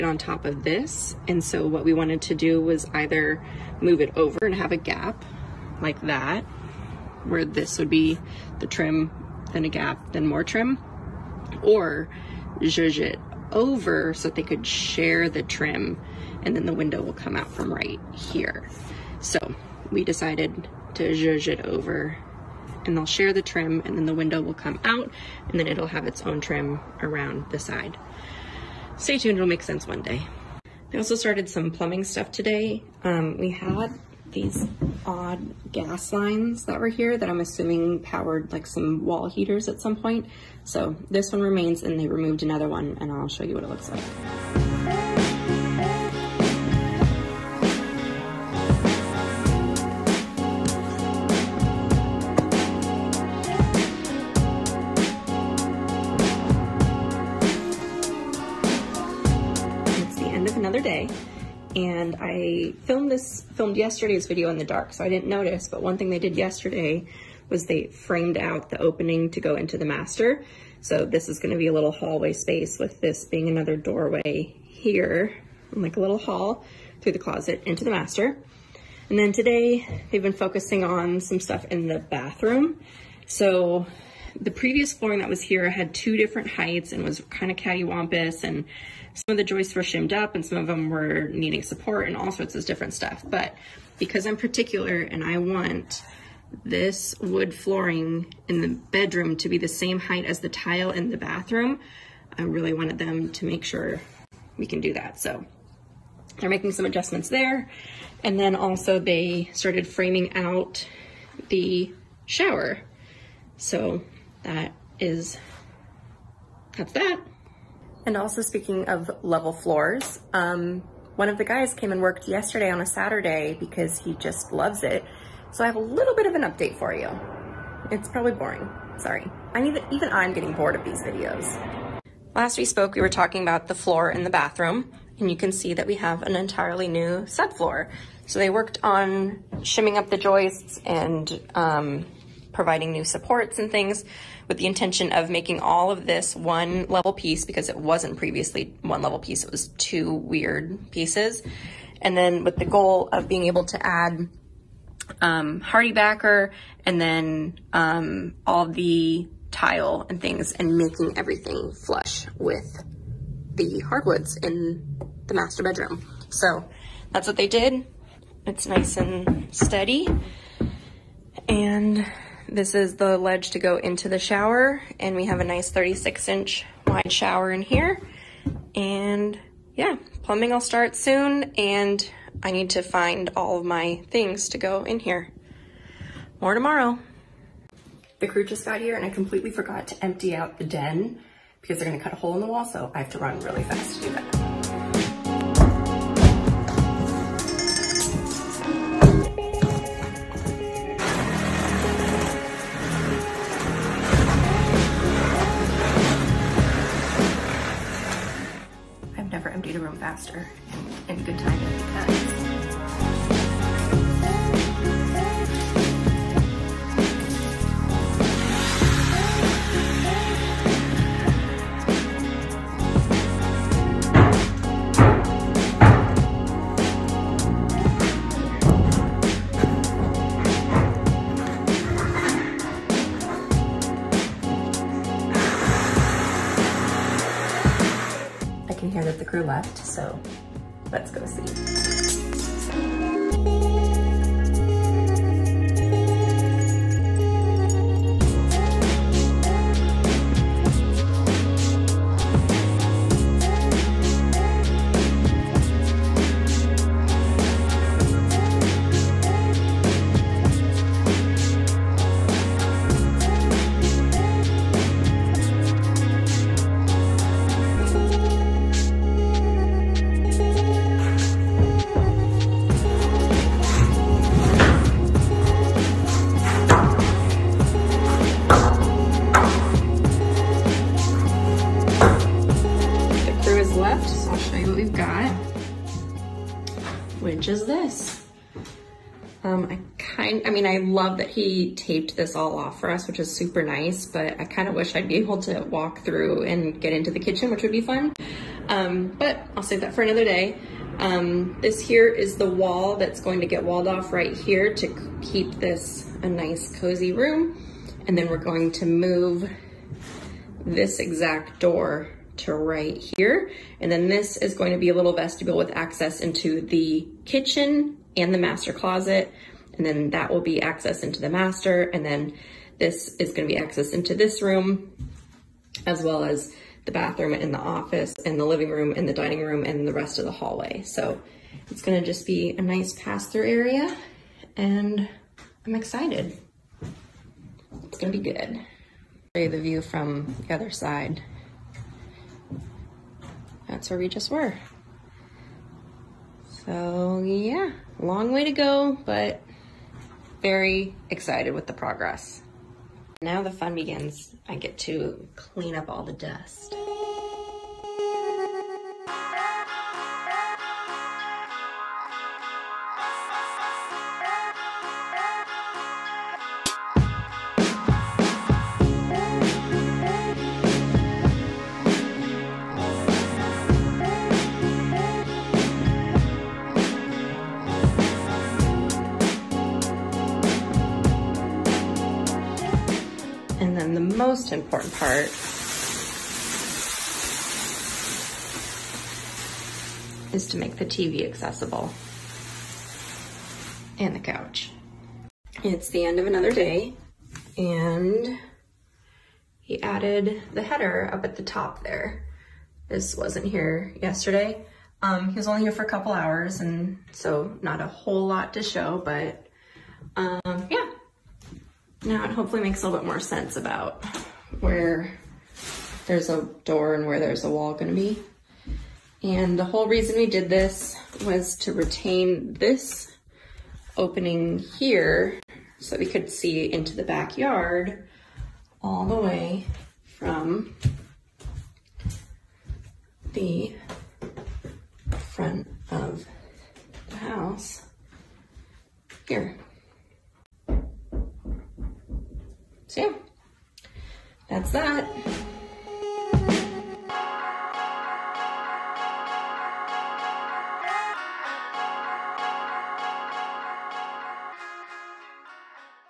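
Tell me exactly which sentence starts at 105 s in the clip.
So they're making some adjustments there.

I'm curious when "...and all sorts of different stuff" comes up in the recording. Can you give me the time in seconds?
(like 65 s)
92 s.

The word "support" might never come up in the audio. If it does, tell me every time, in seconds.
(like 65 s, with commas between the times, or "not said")
91 s, 143 s.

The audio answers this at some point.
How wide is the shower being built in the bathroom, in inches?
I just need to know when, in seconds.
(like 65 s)
175 s.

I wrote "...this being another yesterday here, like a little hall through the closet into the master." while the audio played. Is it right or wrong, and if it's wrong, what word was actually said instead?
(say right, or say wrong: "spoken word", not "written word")
wrong: "doorway", not "yesterday".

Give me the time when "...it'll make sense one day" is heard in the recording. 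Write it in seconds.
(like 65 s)
29 s.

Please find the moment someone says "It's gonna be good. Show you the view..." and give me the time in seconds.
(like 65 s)
337 s.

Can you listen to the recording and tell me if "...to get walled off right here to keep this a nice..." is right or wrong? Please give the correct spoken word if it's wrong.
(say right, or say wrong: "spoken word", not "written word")
right.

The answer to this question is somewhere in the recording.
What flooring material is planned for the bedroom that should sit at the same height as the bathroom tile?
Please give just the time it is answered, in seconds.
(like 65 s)
97 s.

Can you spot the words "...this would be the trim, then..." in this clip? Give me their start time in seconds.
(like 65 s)
7 s.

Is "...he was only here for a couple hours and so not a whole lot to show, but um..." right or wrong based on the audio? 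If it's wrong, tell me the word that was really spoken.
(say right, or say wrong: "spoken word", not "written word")
right.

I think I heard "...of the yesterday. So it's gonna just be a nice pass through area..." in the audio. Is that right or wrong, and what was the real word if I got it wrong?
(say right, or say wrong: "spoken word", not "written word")
wrong: "hallway", not "yesterday".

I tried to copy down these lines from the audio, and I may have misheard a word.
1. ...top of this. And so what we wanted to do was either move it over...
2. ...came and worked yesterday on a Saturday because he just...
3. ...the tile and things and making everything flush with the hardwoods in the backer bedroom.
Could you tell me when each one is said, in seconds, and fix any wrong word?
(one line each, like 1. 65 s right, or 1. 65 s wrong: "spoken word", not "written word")
1. 0 s right
2. 121 s right
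3. 158 s wrong: "master", not "backer".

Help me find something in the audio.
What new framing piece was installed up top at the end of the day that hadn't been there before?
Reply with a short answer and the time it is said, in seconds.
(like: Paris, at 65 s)
The header, at 400 s.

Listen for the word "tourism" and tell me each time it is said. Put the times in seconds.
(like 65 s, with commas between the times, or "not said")
not said.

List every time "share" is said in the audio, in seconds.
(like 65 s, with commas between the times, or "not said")
14 s, 23 s.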